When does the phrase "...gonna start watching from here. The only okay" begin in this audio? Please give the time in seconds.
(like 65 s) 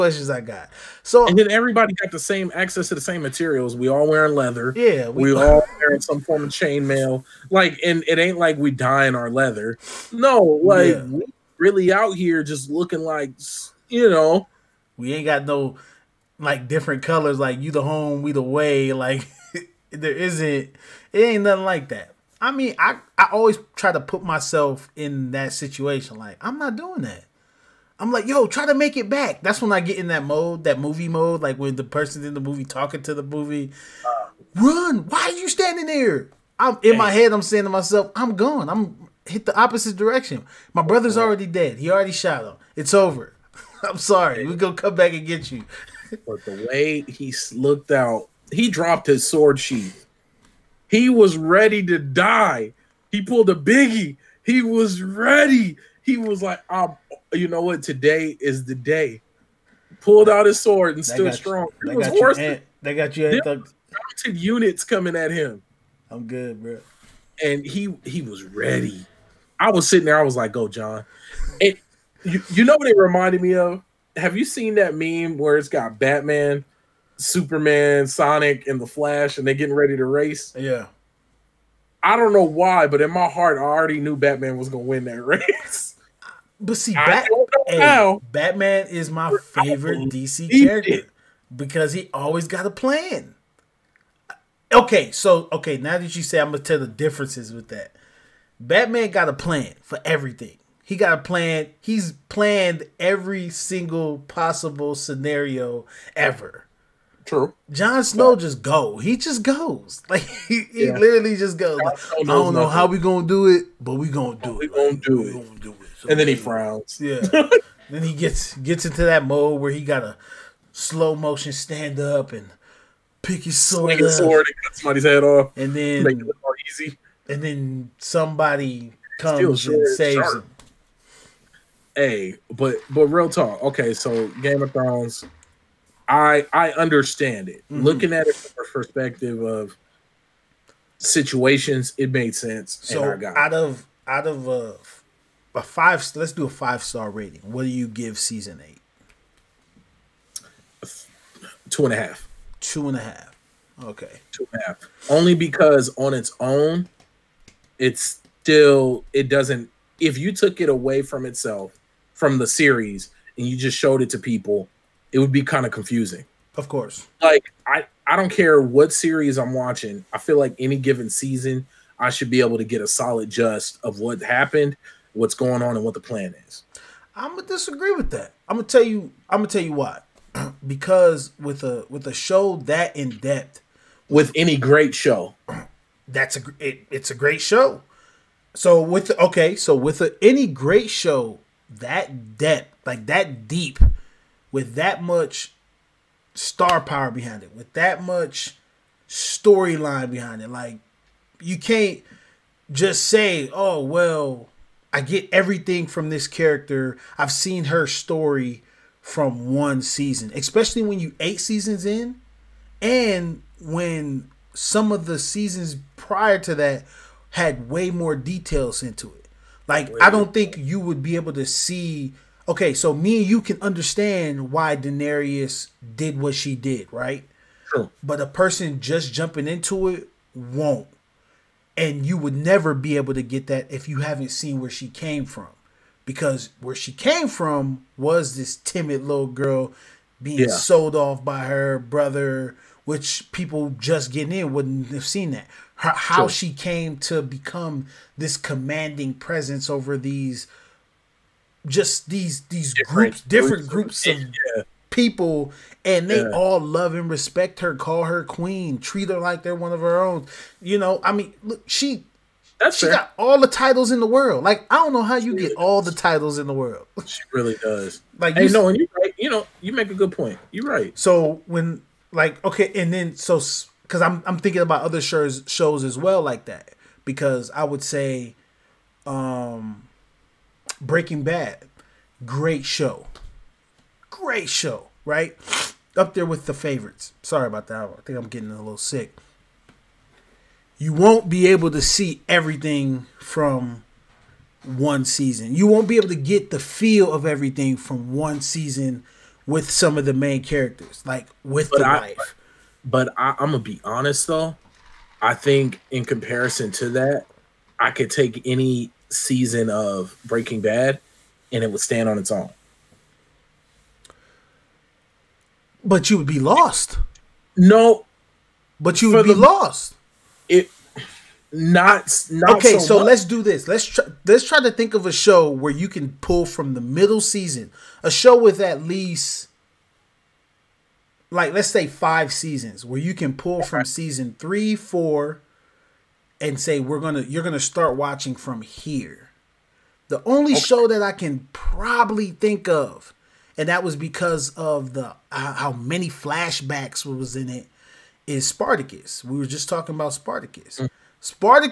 337 s.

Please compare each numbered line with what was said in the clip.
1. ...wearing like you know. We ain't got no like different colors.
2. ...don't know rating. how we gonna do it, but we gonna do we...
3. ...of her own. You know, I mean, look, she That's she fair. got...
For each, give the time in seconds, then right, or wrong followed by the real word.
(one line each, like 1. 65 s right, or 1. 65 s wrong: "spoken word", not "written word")
1. 12 s wrong: "looking", not "wearing"
2. 112 s wrong: "nothing", not "rating"
3. 259 s right.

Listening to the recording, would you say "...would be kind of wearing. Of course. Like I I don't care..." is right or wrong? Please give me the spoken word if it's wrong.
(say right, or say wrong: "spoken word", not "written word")
wrong: "confusing", not "wearing".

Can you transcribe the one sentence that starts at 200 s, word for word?
Like, you can't just say, oh, well, I get everything from this character.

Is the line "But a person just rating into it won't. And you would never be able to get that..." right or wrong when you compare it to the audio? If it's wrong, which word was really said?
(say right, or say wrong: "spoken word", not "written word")
wrong: "jumping", not "rating".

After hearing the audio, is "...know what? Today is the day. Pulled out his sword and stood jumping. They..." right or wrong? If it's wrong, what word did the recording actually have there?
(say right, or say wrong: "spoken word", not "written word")
wrong: "strong", not "jumping".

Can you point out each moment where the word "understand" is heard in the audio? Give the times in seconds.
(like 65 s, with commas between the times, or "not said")
136 s, 223 s.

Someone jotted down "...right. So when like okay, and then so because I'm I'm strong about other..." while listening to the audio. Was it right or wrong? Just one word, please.
wrong.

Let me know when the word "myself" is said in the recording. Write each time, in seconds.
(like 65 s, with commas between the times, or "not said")
24 s, 37 s.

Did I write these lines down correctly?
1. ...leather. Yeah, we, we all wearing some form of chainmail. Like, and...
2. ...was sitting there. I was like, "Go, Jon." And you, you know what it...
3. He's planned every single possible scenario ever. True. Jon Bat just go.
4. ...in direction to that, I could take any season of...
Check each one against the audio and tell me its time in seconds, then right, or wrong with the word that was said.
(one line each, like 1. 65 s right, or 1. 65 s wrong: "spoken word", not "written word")
1. 4 s right
2. 69 s right
3. 101 s wrong: "Snow", not "Bat"
4. 305 s wrong: "comparison", not "direction".